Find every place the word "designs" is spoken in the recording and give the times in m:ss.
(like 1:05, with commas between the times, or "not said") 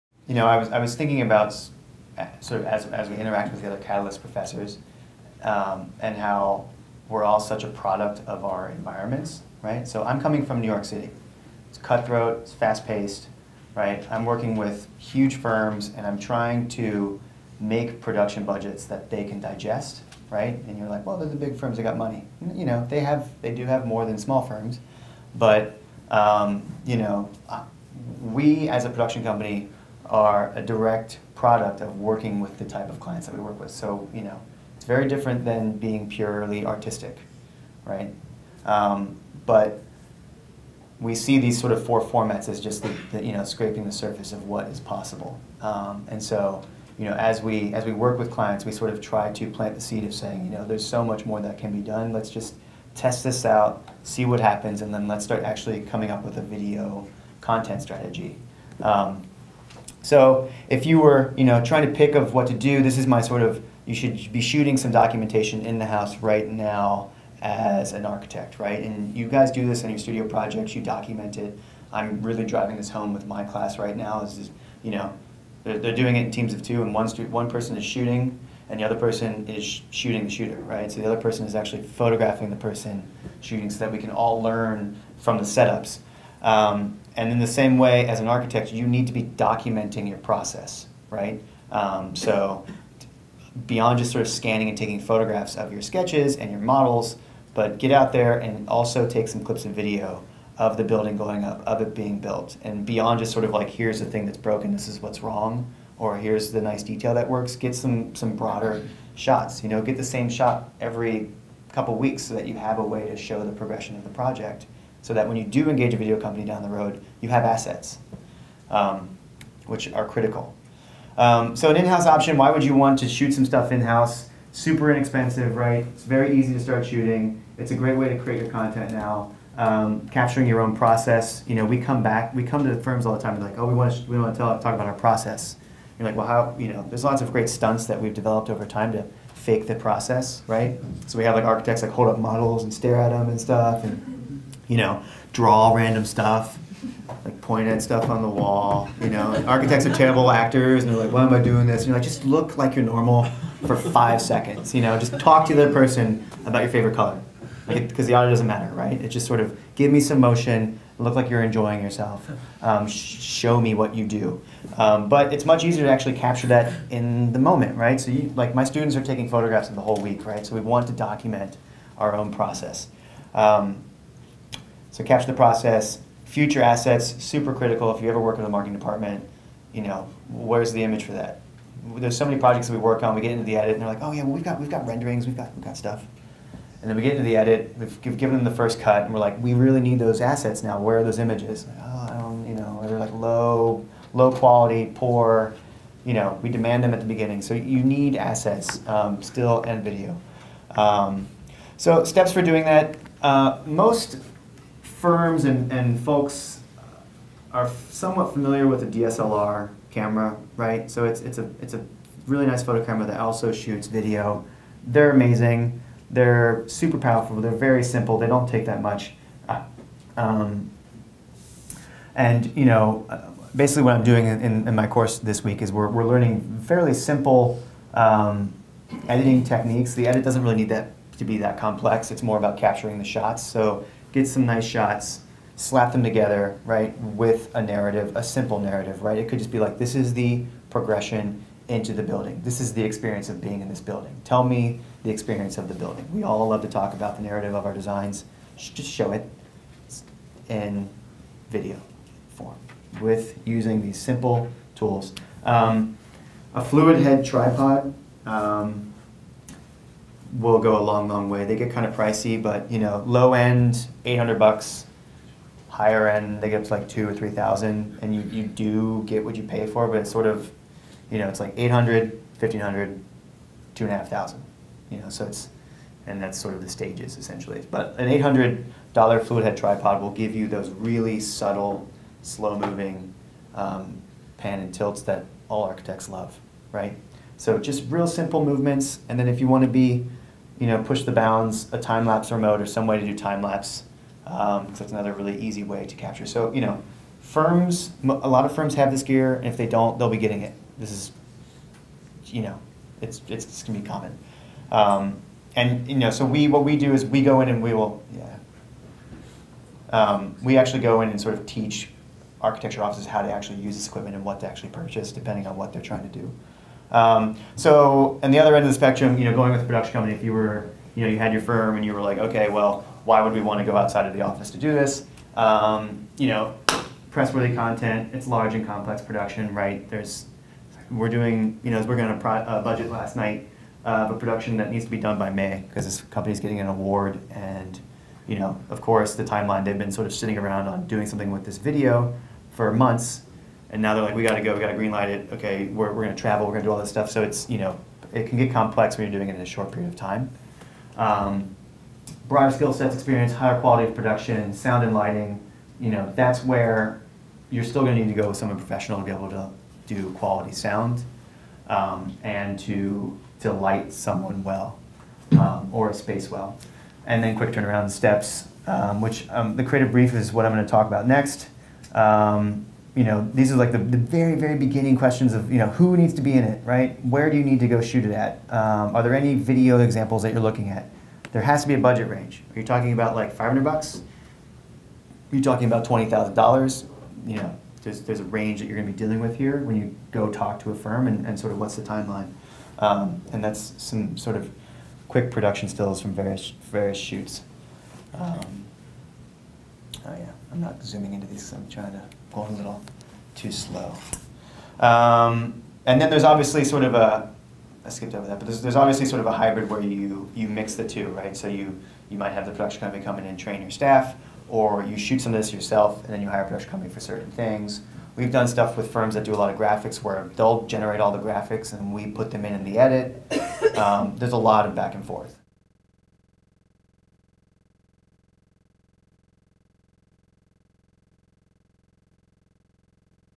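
4:07.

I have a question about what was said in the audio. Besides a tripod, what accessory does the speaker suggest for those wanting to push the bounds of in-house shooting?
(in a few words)
time lapse remote.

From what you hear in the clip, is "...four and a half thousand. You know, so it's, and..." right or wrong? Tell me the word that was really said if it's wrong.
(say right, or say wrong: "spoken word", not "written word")
wrong: "two", not "four".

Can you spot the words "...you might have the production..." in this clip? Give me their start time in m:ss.
6:52.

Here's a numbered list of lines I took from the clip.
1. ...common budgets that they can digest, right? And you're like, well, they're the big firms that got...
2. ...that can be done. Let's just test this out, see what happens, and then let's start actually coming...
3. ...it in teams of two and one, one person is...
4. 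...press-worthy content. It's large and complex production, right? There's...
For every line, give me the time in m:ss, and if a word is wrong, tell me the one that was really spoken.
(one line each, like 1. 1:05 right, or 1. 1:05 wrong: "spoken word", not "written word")
1. 0:17 wrong: "production", not "common"
2. 0:51 right
3. 1:16 right
4. 5:27 right.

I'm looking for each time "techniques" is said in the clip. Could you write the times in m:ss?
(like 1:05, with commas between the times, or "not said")
3:49.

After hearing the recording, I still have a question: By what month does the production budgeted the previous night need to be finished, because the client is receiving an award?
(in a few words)
May.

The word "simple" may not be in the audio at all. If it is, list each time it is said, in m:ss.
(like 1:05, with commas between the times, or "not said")
3:37, 3:46, 3:58, 4:13, 4:48.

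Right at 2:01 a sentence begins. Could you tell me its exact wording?
Um, so an in-house option, why would you want to shoot some stuff in-house?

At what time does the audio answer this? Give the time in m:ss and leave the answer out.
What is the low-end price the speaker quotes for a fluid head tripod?
4:24.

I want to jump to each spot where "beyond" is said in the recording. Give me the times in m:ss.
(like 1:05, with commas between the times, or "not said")
1:33, 1:42.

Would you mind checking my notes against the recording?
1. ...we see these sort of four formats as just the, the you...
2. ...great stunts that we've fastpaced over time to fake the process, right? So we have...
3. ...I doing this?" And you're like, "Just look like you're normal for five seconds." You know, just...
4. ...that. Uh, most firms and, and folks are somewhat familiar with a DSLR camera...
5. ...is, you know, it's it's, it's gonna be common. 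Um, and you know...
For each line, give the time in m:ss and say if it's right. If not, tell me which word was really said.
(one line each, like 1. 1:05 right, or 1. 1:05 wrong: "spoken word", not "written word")
1. 0:40 right
2. 2:17 wrong: "developed", not "fastpaced"
3. 2:31 right
4. 3:22 right
5. 5:00 right.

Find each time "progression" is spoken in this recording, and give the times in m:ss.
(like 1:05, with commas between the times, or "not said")
1:53, 4:00.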